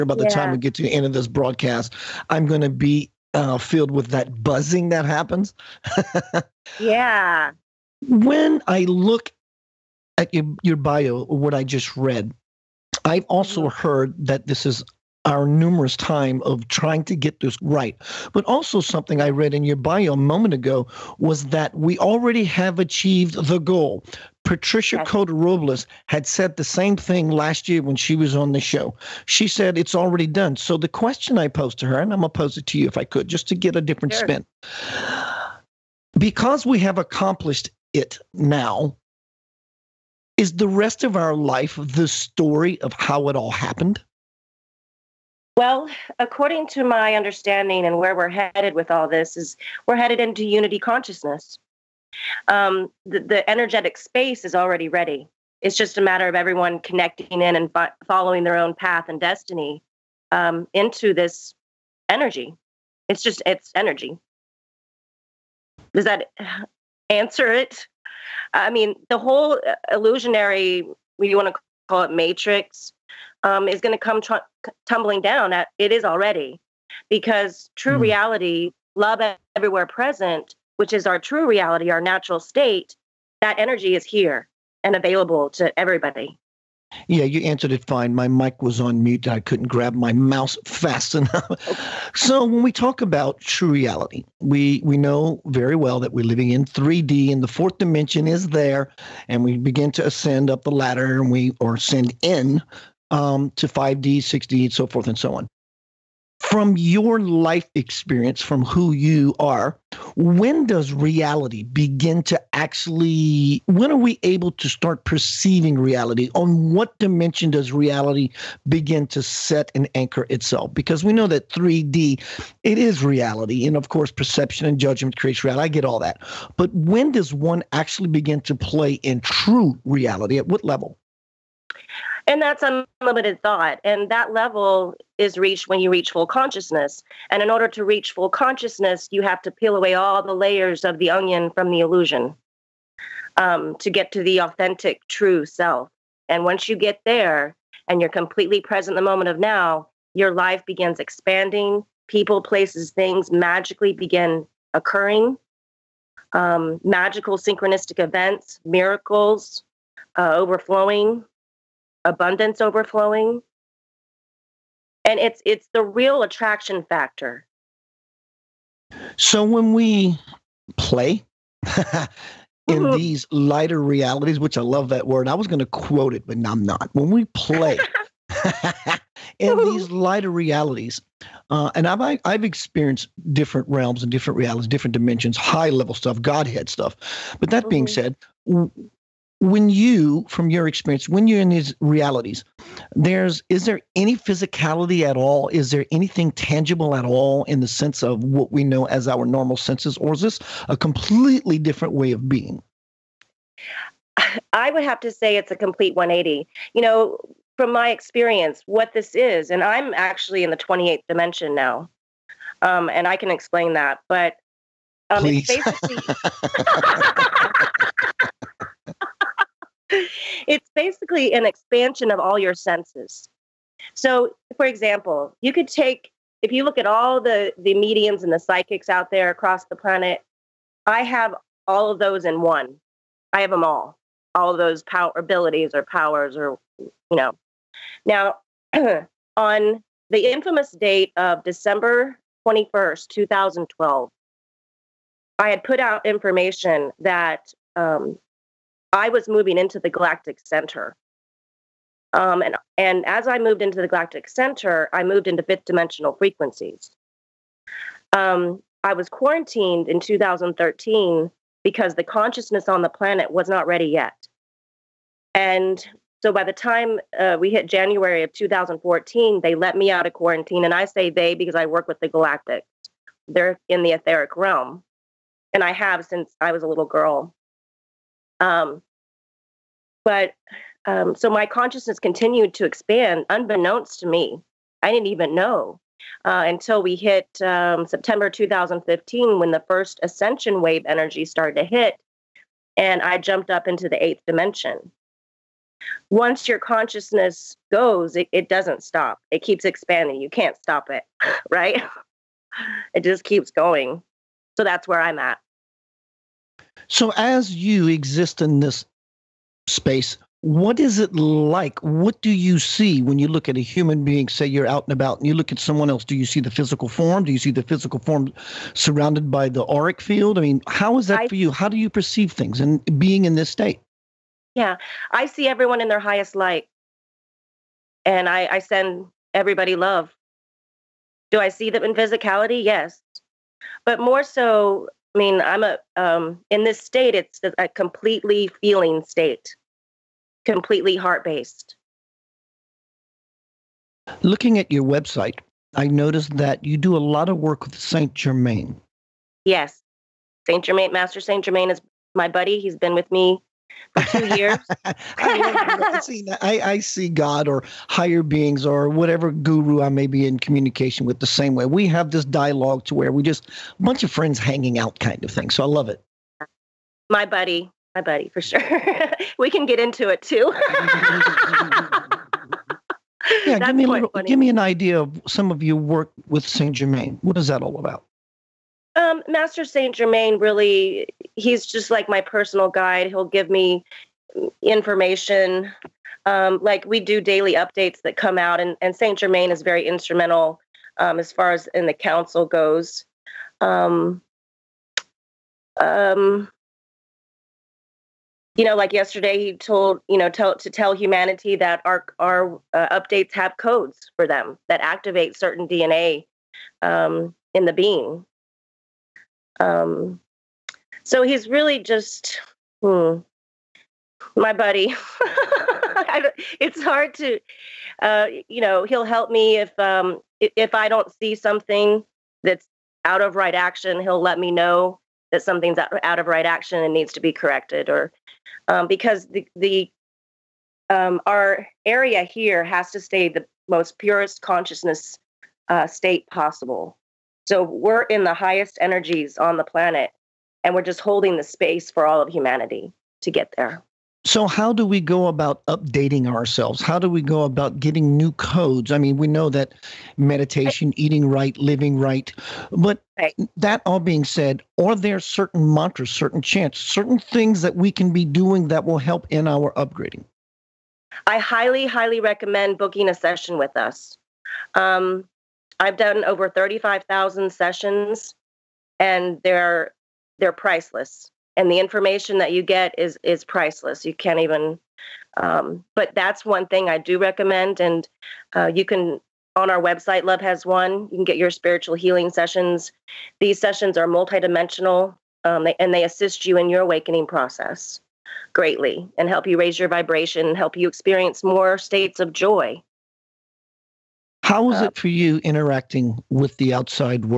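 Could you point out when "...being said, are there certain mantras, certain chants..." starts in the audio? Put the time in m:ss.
7:33.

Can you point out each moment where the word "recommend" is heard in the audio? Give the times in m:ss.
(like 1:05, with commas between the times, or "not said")
7:42, 7:57.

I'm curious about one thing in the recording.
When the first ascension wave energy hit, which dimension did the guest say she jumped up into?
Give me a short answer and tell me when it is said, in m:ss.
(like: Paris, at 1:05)
Eighth dimension, at 4:54.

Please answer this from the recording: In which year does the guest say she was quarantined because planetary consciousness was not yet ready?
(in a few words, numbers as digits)
2013.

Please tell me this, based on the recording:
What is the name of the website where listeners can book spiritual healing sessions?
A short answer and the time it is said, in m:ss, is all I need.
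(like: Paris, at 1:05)
Love Has Won, at 8:00.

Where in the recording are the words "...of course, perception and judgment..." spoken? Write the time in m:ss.
2:03.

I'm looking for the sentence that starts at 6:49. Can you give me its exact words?
Um, so he's really just hmm, my buddy.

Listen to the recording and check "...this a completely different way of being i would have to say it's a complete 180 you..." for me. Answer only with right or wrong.
right.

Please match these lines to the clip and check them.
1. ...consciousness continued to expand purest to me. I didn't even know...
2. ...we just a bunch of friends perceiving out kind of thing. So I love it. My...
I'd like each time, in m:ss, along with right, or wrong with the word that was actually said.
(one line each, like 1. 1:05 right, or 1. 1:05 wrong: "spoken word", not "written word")
1. 4:41 wrong: "unbeknownst", not "purest"
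2. 6:03 wrong: "hanging", not "perceiving".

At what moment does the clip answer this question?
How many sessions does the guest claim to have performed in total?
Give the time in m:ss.
7:46.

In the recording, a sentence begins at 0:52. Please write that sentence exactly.
Um, the, the, energetic space is already ready.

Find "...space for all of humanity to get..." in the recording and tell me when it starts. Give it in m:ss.
7:21.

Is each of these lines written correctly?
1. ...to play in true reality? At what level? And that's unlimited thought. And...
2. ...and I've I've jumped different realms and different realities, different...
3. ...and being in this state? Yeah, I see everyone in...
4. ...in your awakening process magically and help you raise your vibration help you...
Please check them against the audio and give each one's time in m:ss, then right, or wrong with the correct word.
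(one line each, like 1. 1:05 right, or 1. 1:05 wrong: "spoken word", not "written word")
1. 2:08 right
2. 3:01 wrong: "experienced", not "jumped"
3. 5:22 right
4. 8:06 wrong: "greatly", not "magically".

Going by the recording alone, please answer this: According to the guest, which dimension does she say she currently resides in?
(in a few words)
28th dimension.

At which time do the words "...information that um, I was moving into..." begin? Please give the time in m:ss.
4:06.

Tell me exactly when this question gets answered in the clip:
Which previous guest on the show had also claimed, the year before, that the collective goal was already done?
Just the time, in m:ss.
0:24.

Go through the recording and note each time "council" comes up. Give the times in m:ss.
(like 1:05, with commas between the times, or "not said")
6:31.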